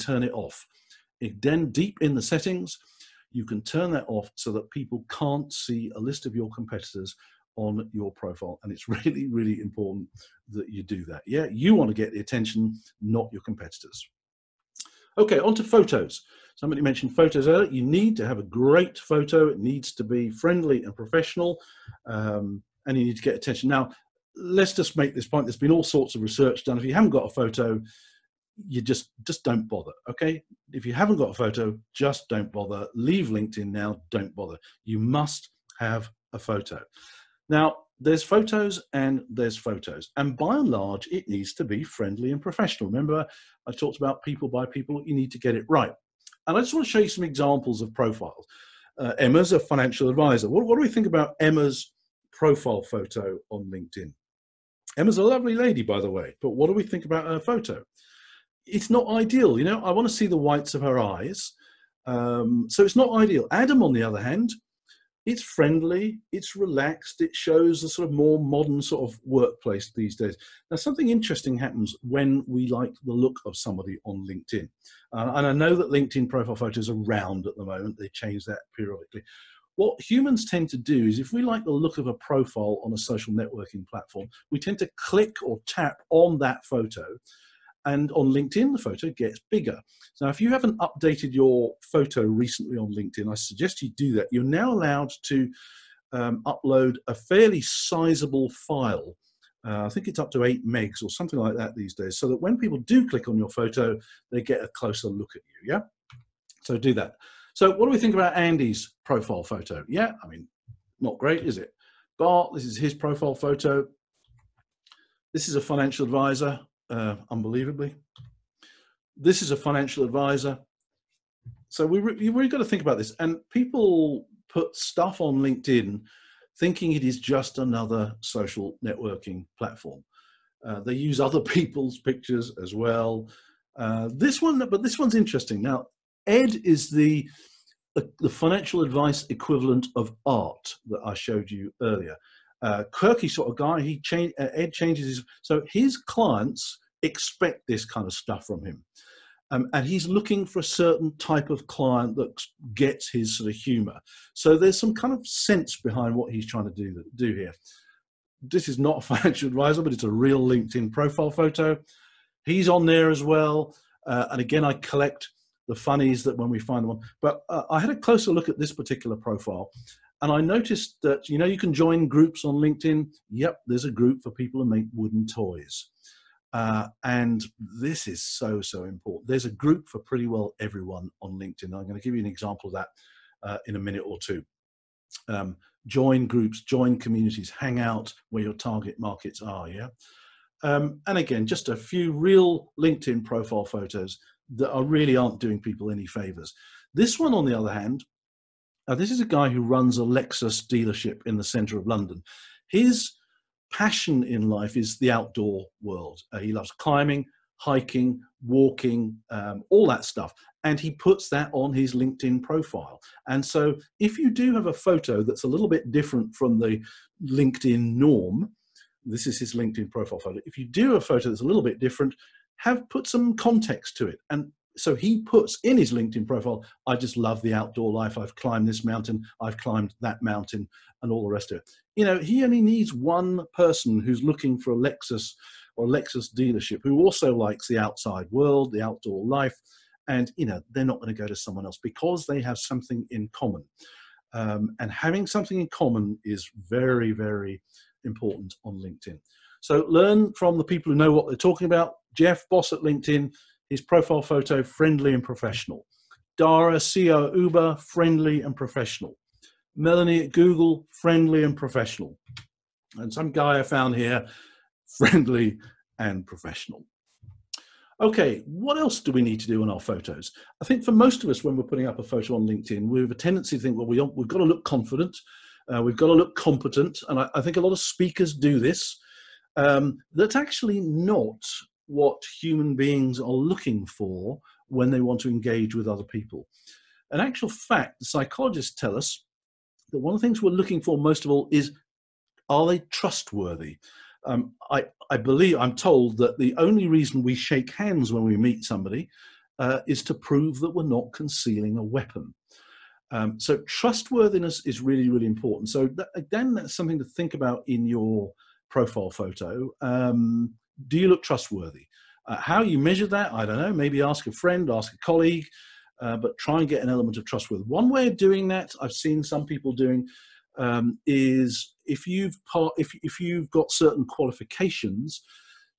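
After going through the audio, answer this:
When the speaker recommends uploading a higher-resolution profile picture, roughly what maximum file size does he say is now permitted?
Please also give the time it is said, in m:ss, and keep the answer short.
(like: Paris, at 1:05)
8 megs, at 1:40.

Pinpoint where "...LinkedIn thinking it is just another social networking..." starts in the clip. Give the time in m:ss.
2:05.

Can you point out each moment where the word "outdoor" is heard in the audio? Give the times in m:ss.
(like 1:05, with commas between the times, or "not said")
3:25, 3:47, 3:58.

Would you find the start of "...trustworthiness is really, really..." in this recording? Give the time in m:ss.
5:03.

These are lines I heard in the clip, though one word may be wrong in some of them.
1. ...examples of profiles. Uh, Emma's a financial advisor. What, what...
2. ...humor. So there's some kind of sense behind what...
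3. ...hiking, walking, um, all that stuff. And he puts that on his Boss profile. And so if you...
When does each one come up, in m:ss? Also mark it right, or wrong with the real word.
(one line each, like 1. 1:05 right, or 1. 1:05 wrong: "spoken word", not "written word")
1. 0:47 right
2. 2:33 right
3. 3:27 wrong: "LinkedIn", not "Boss".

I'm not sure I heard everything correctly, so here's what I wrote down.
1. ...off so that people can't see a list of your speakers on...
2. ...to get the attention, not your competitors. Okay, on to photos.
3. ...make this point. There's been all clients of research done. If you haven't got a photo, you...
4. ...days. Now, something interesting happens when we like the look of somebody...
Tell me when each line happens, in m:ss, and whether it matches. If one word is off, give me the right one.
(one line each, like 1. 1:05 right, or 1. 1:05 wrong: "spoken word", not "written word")
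1. 0:04 wrong: "competitors", not "speakers"
2. 0:11 right
3. 0:24 wrong: "sorts", not "clients"
4. 1:10 right.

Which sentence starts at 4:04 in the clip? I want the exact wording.
Um, and having something in common is very, very important on LinkedIn.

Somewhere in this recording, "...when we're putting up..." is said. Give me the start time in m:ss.
4:31.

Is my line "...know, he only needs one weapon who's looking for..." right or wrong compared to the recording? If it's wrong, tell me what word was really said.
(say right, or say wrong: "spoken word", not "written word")
wrong: "person", not "weapon".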